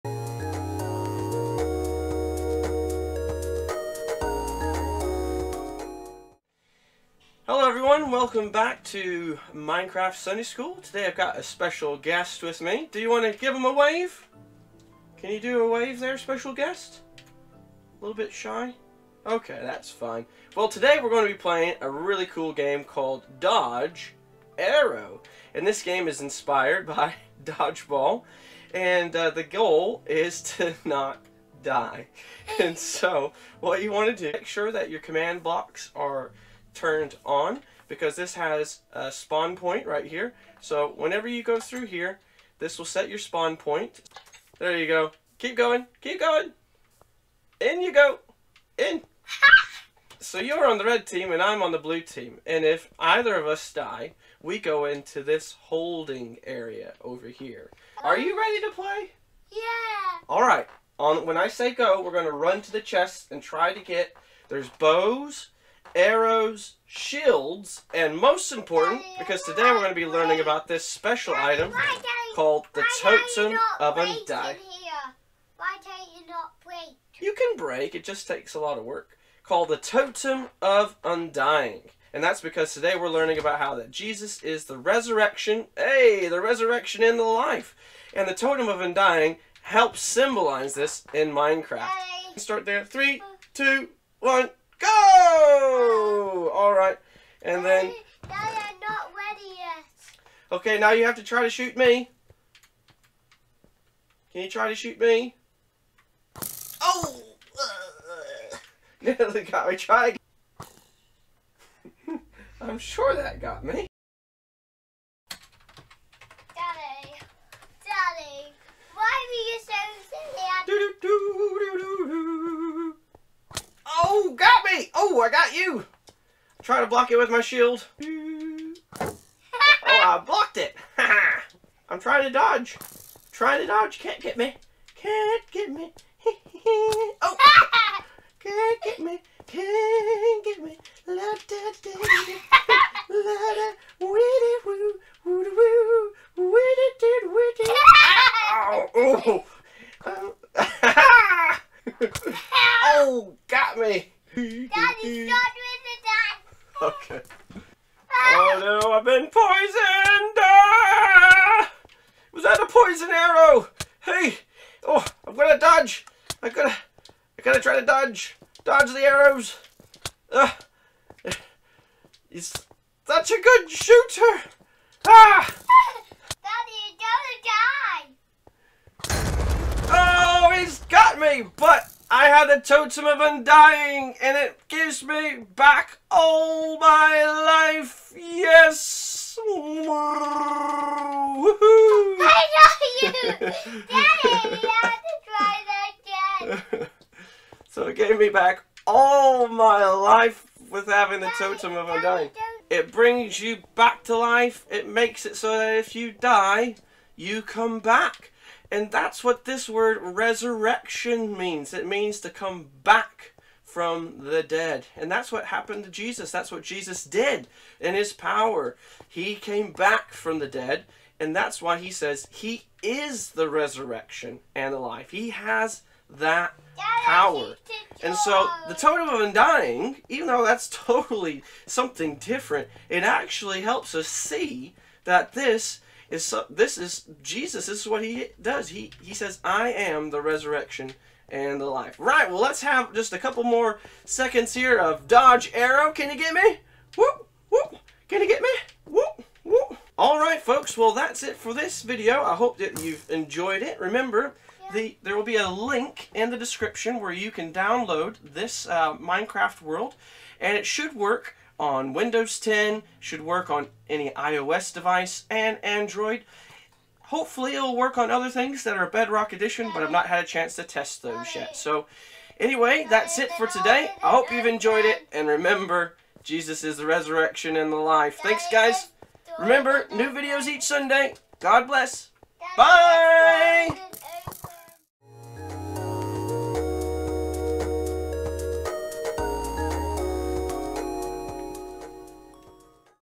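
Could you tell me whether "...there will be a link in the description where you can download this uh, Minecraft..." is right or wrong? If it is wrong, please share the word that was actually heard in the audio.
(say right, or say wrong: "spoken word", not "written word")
right.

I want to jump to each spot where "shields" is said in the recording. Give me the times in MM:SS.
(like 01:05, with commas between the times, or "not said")
01:06, 02:07.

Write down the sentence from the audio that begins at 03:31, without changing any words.
It means to come back from the dead.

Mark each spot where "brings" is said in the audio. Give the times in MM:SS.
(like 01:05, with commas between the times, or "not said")
03:22.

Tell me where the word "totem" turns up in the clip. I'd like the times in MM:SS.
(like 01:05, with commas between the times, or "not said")
01:13, 01:19, 01:28, 03:02, 03:21, 03:48.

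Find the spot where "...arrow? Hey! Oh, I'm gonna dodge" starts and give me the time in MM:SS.
02:43.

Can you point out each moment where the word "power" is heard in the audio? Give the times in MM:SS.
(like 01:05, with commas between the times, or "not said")
03:38, 03:46.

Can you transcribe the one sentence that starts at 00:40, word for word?
So whenever you go through here, this will set your spawn point.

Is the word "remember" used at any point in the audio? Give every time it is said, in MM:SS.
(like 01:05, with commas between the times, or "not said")
04:13, 04:35, 04:39.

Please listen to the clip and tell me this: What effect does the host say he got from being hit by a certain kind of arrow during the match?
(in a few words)
Poisoned.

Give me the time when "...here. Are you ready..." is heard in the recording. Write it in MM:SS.
00:57.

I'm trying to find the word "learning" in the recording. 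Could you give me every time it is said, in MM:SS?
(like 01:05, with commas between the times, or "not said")
01:10, 01:23.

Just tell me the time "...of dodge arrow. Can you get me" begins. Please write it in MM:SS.
04:04.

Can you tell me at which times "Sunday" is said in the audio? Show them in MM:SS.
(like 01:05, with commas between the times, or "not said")
00:10, 04:40.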